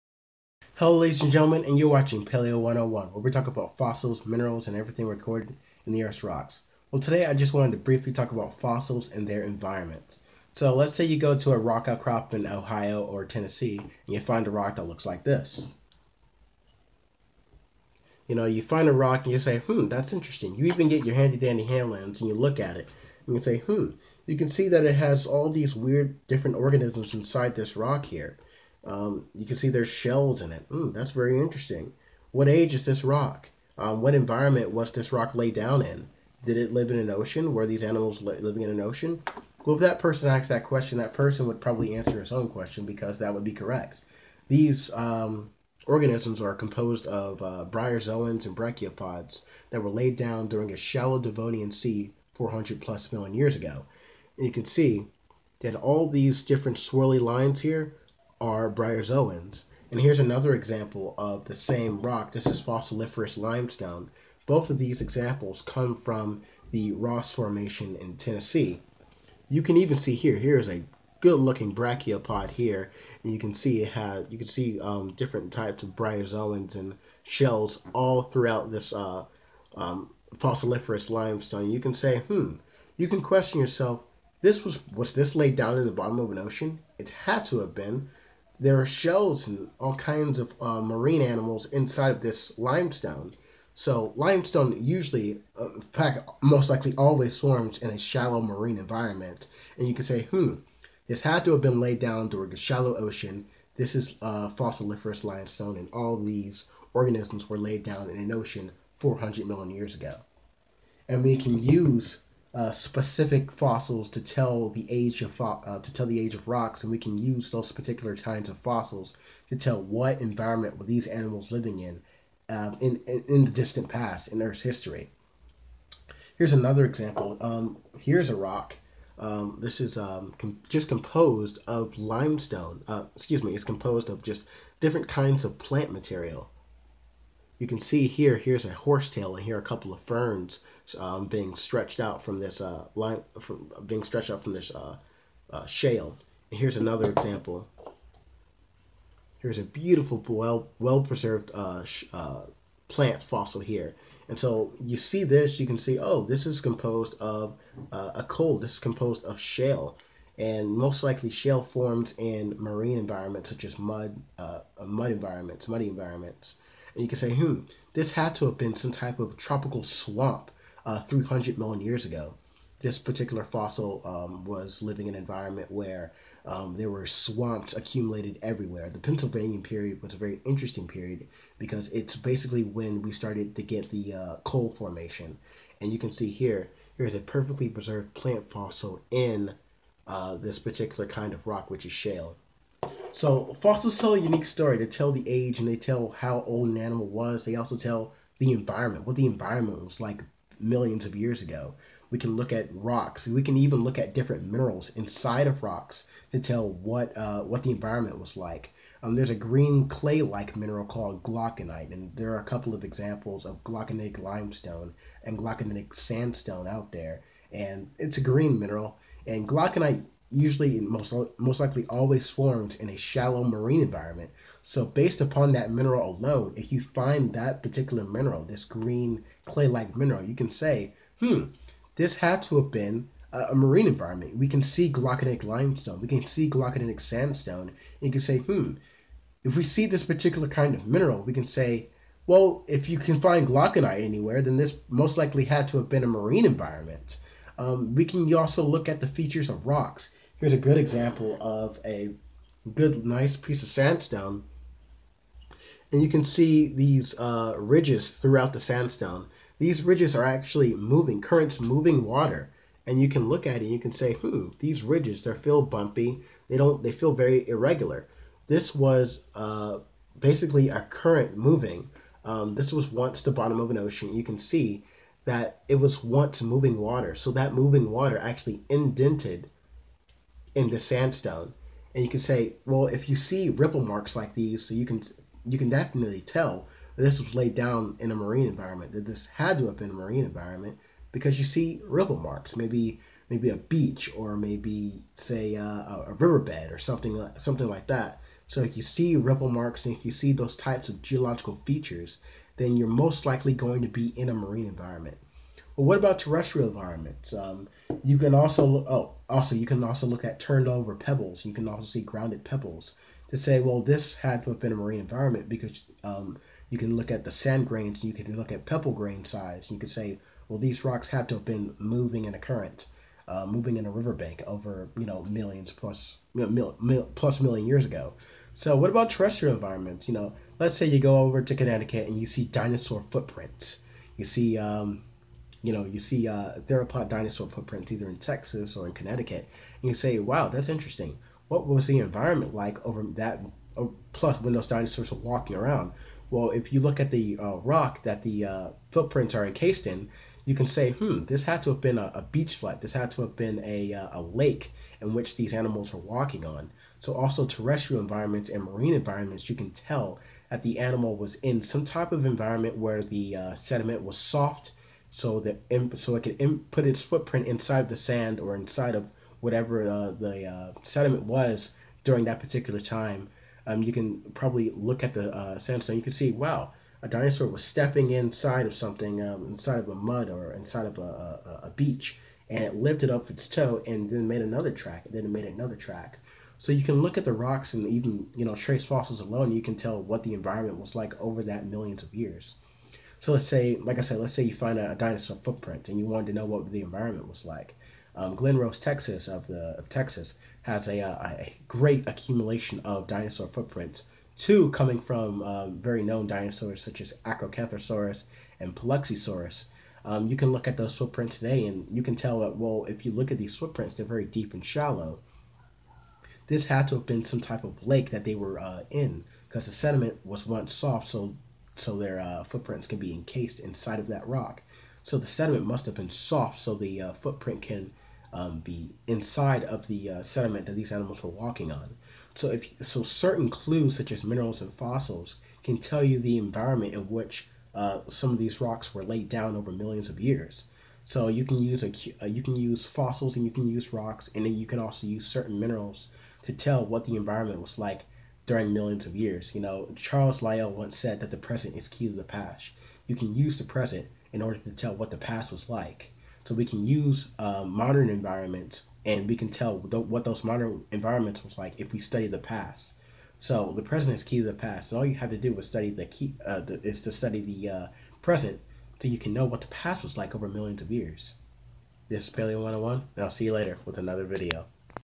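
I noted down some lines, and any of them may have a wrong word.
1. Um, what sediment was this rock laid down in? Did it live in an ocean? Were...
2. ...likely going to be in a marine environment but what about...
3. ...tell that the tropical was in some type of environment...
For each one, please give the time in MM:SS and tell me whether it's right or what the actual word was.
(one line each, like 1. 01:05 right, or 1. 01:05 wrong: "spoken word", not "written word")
1. 00:33 wrong: "environment", not "sediment"
2. 05:03 right
3. 05:59 wrong: "animal", not "tropical".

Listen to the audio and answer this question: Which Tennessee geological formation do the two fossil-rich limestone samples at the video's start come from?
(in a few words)
Ross Formation.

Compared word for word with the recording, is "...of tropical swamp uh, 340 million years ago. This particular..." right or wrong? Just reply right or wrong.
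wrong.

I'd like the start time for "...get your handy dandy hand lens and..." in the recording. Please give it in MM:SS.
00:20.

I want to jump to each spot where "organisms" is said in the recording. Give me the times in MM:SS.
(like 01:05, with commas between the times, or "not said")
00:26, 00:45, 01:46.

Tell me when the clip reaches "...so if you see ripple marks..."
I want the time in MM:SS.
04:58.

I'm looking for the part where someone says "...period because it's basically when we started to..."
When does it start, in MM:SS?
03:00.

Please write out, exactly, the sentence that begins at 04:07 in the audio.
Um, we can also look at the features of rocks here's a good example of a good, nice piece of sandstone.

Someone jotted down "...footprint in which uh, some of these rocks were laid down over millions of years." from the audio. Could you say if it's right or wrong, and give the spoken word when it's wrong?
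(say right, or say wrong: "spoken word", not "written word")
wrong: "environment", not "footprint".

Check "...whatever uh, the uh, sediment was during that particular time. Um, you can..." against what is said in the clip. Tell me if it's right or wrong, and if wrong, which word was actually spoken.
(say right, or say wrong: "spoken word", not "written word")
right.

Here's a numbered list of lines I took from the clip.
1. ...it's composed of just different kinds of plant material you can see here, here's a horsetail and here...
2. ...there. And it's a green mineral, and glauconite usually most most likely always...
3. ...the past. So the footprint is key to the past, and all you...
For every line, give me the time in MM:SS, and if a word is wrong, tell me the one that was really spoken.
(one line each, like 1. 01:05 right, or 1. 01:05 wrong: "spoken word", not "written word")
1. 02:13 right
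2. 03:36 right
3. 07:42 wrong: "present", not "footprint".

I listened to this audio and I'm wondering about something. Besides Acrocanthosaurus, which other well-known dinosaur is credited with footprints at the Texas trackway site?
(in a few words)
Paluxysaurus.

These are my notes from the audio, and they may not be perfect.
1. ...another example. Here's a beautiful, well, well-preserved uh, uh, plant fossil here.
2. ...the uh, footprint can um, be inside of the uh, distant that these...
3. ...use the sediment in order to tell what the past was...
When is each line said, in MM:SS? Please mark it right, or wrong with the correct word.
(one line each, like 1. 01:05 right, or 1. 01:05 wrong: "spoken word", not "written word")
1. 02:26 right
2. 07:06 wrong: "sediment", not "distant"
3. 07:33 wrong: "present", not "sediment".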